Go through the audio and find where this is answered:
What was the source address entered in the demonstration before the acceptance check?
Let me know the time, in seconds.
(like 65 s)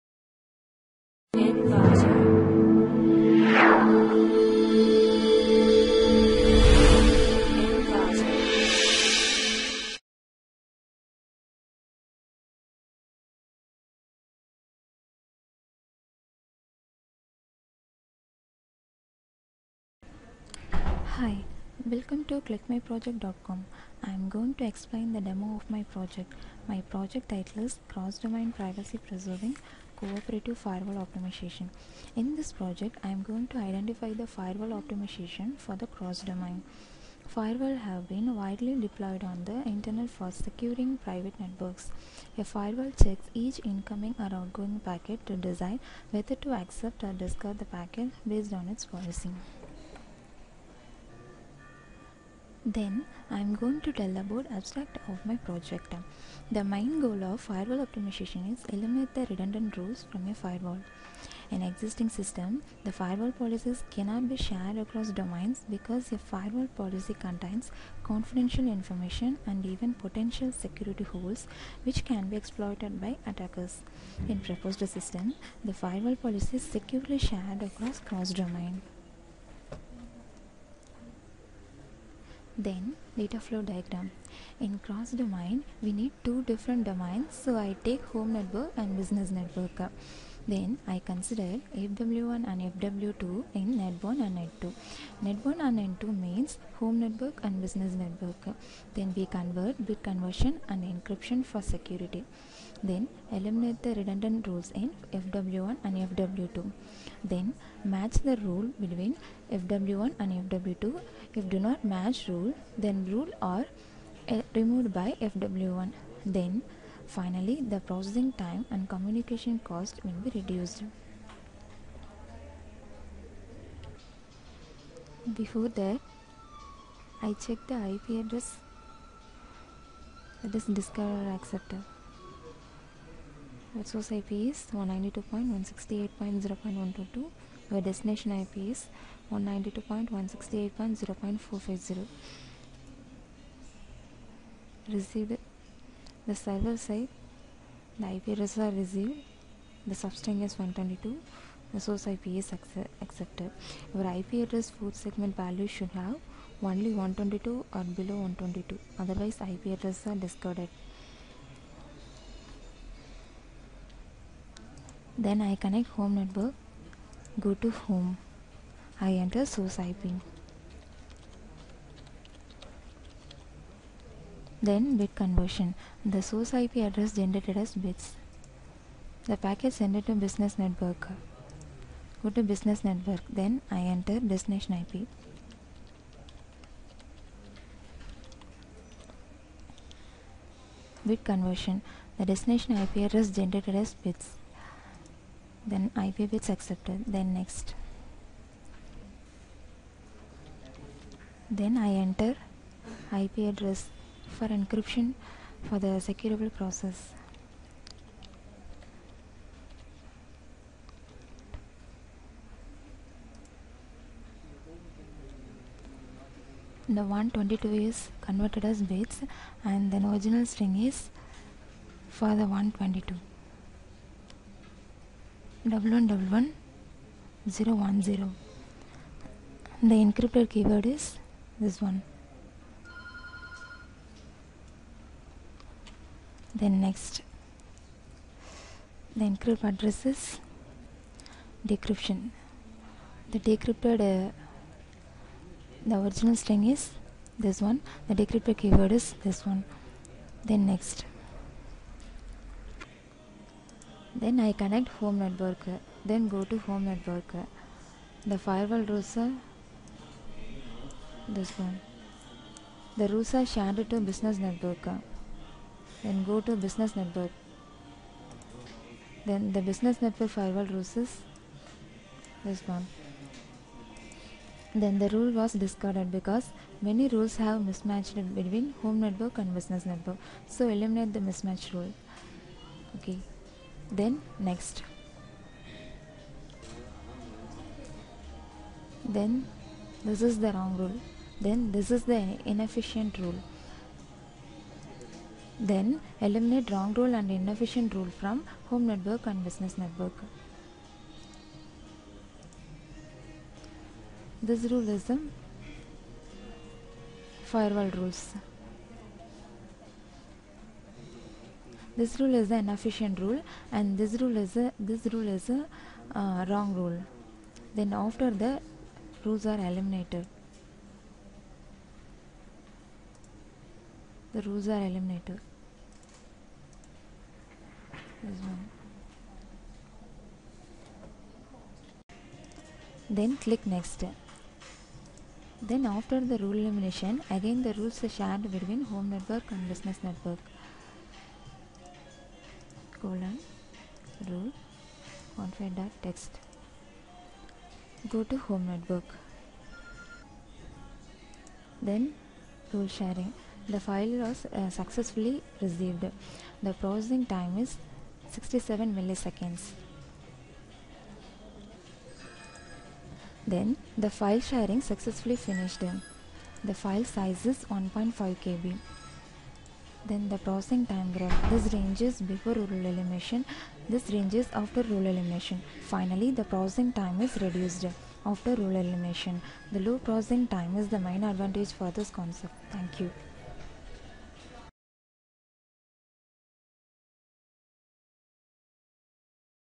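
134 s.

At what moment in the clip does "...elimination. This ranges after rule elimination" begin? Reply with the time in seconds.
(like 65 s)
372 s.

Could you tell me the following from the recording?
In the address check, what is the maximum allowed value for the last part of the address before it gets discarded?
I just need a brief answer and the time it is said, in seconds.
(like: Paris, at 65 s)
122, at 156 s.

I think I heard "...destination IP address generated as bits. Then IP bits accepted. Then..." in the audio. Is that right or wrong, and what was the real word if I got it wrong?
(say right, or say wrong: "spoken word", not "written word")
right.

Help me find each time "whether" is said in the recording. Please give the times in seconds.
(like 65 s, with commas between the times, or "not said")
46 s.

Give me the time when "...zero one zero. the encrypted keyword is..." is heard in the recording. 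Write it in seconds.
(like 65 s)
227 s.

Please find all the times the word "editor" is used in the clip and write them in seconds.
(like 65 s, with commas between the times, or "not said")
not said.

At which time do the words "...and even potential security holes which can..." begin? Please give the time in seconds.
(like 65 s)
69 s.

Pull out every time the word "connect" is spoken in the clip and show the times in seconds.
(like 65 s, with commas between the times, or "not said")
165 s, 254 s.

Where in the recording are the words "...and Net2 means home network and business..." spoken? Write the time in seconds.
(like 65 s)
95 s.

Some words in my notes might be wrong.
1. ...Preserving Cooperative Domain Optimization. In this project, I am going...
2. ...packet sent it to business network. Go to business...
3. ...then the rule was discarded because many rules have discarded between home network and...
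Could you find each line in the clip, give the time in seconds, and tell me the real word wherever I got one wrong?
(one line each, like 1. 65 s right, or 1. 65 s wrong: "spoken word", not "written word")
1. 28 s wrong: "Firewall", not "Domain"
2. 179 s right
3. 274 s wrong: "mismatched", not "discarded".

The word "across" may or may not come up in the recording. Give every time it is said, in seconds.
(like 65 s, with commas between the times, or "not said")
64 s, 77 s.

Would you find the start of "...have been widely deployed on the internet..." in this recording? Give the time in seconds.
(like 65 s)
37 s.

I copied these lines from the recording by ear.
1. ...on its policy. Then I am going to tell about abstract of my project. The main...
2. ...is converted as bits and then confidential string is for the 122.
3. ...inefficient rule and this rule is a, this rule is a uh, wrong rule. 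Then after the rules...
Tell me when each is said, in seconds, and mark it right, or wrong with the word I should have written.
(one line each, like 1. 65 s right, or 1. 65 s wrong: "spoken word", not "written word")
1. 48 s right
2. 217 s wrong: "original", not "confidential"
3. 312 s right.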